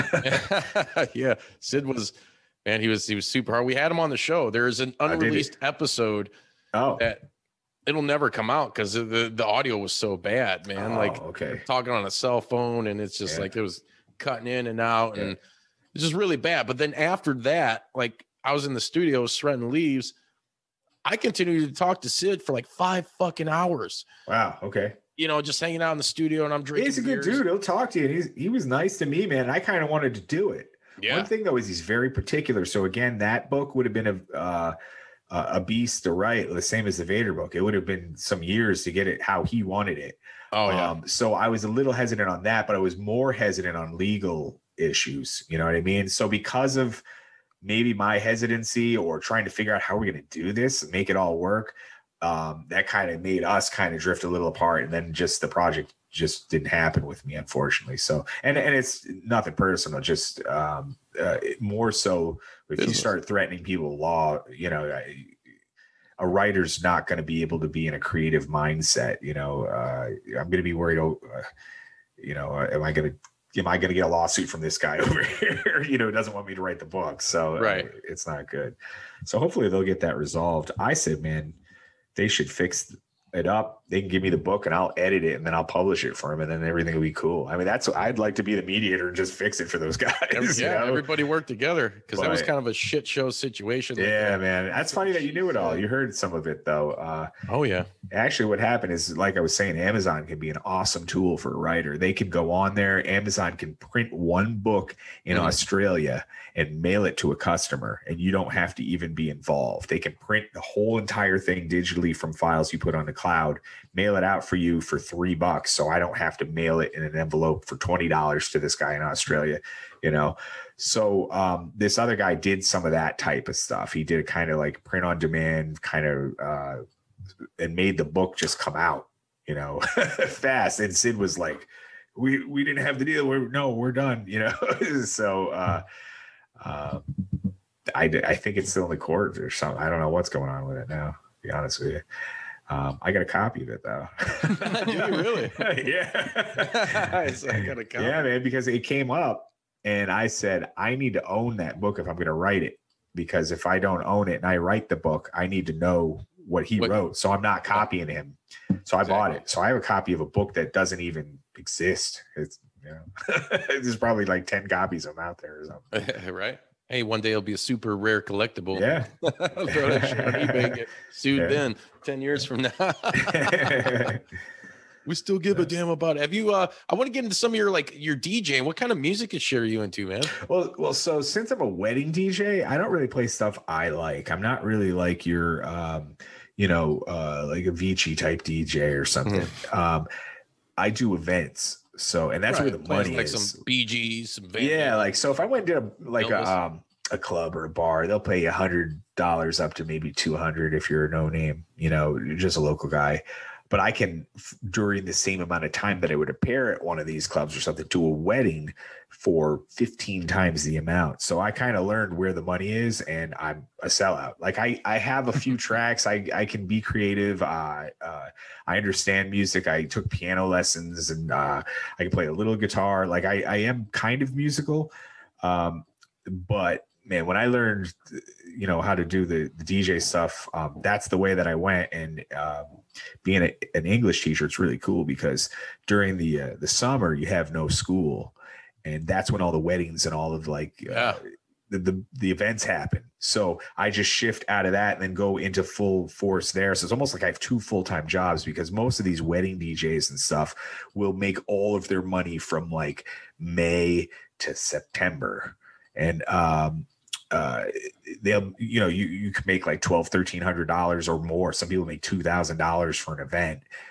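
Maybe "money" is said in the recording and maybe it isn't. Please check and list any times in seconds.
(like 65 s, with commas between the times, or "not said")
192 s, 212 s, 252 s.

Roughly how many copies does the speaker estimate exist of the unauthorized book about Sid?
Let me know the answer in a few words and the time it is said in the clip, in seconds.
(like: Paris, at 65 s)
10, at 164 s.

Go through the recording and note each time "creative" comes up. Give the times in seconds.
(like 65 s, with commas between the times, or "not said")
67 s, 216 s.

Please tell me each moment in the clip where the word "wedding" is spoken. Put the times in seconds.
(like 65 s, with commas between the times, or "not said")
181 s, 208 s, 239 s, 249 s.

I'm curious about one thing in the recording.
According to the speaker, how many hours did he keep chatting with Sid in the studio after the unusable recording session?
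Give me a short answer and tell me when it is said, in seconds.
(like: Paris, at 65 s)
5, at 22 s.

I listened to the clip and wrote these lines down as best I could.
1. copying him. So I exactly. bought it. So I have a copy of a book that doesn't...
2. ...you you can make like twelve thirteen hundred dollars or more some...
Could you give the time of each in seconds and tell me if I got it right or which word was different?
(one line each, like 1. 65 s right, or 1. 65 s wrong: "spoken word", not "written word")
1. 157 s right
2. 258 s right.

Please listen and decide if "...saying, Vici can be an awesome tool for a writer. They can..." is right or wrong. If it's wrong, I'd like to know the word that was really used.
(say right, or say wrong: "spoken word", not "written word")
wrong: "Amazon", not "Vici".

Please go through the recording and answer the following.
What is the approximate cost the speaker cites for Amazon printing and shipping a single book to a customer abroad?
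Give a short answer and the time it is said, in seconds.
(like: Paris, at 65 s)
$3, at 114 s.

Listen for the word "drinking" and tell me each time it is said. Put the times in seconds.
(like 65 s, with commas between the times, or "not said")
26 s.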